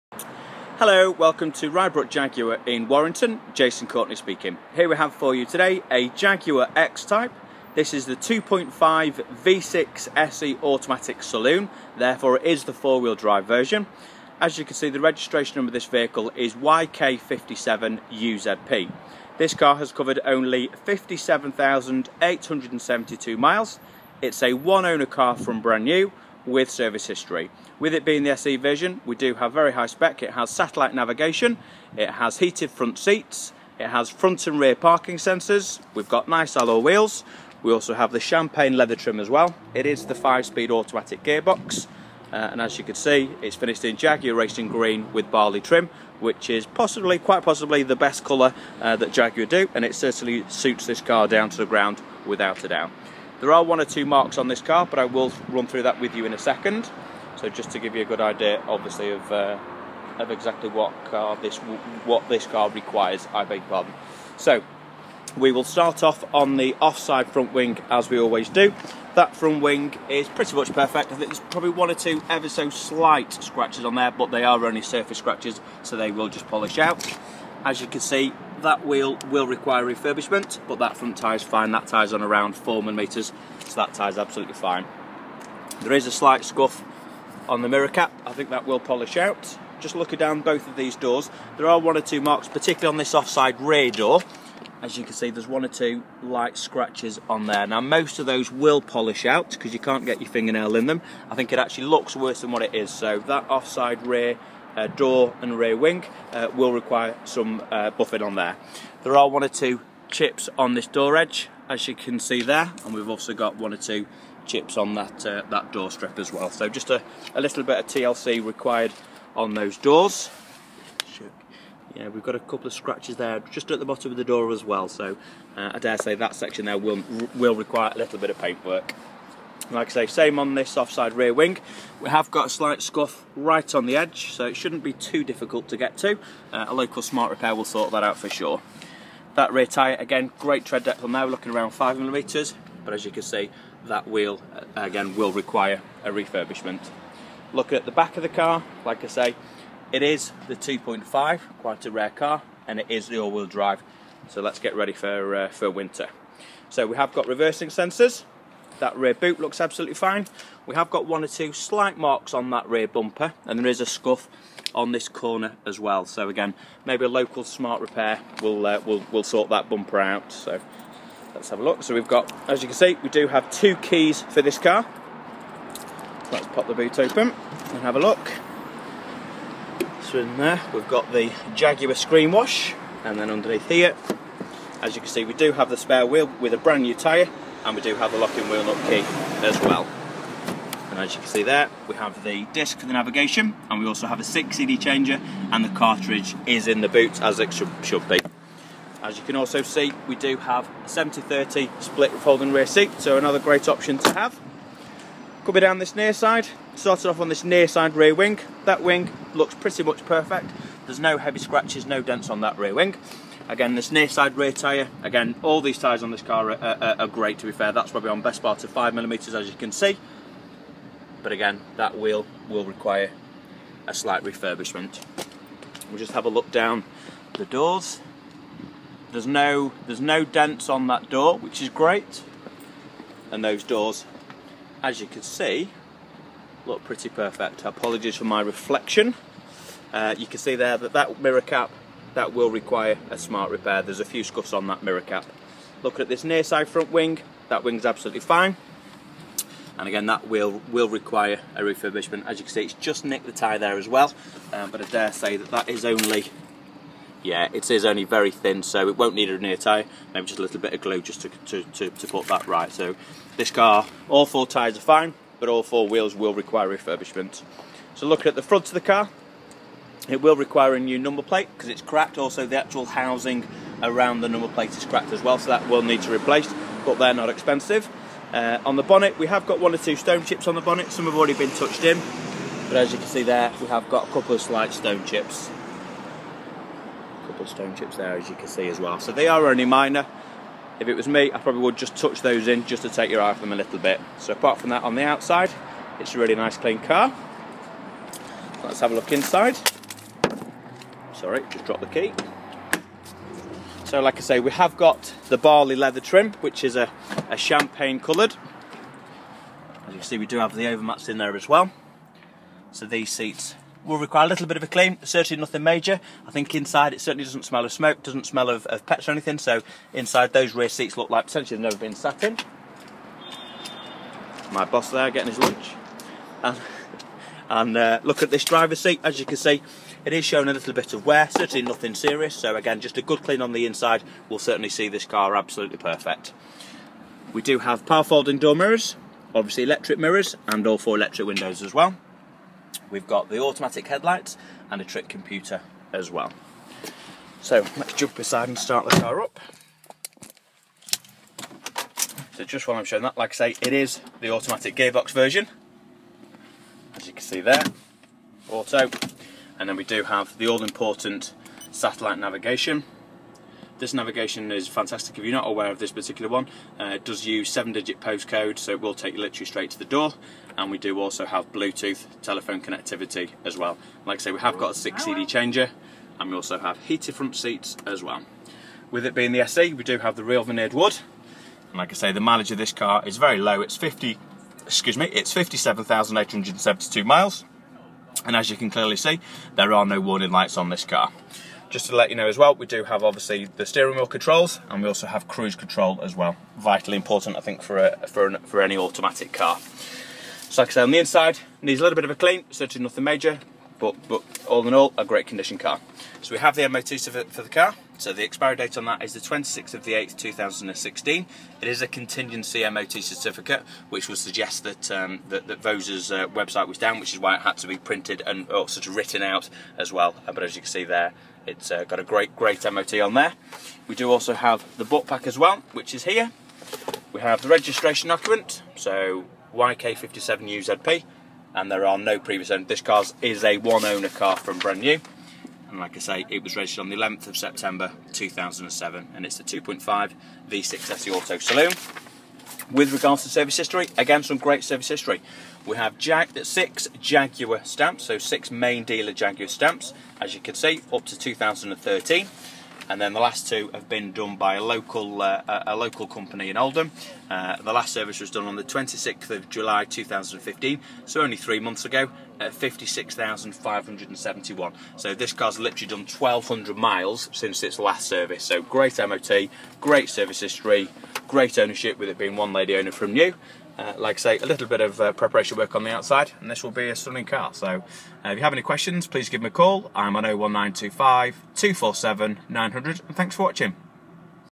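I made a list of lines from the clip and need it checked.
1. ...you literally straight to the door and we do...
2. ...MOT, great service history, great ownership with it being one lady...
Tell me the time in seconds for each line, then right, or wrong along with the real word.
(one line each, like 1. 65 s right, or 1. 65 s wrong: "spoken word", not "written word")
1. 369 s right
2. 468 s right.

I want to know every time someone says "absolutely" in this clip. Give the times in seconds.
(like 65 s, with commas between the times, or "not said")
84 s, 159 s, 247 s, 335 s.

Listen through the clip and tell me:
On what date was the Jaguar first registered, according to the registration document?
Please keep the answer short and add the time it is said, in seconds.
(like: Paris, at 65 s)
11 September 2007, at 436 s.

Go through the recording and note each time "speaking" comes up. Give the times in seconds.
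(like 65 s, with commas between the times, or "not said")
4 s.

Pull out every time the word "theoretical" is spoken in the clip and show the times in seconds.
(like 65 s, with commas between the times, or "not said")
not said.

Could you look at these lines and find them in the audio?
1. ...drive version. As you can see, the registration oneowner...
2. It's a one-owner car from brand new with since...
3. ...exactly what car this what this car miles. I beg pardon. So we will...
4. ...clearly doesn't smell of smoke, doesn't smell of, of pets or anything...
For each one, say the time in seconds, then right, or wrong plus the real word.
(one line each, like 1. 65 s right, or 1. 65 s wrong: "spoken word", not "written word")
1. 13 s wrong: "number", not "oneowner"
2. 24 s wrong: "service", not "since"
3. 60 s wrong: "requires", not "miles"
4. 317 s wrong: "certainly", not "clearly".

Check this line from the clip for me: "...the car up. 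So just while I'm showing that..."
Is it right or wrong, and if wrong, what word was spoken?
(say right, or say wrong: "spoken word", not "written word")
right.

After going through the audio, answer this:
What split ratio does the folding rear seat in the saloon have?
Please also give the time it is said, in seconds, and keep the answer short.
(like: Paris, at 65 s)
70-30, at 200 s.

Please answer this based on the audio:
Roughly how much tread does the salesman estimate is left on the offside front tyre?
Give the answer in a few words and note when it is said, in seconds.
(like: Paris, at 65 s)
4mm, at 82 s.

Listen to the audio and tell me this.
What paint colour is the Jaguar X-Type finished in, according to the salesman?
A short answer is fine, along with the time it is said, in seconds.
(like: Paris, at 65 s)
Jaguar Racing Green, at 43 s.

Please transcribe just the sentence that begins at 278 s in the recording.
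Uh, on the bonnet, we have got one or two stone chips on the bonnet.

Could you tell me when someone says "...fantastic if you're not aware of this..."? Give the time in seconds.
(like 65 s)
364 s.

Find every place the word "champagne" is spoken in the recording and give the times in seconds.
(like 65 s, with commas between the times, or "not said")
38 s, 307 s.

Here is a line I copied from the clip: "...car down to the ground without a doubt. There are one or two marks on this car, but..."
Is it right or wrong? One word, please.
right.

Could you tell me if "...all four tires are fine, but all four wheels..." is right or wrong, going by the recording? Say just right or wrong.
right.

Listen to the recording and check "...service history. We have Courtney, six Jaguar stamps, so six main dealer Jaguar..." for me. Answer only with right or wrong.
wrong.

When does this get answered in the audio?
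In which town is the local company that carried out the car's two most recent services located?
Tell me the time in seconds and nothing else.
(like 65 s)
456 s.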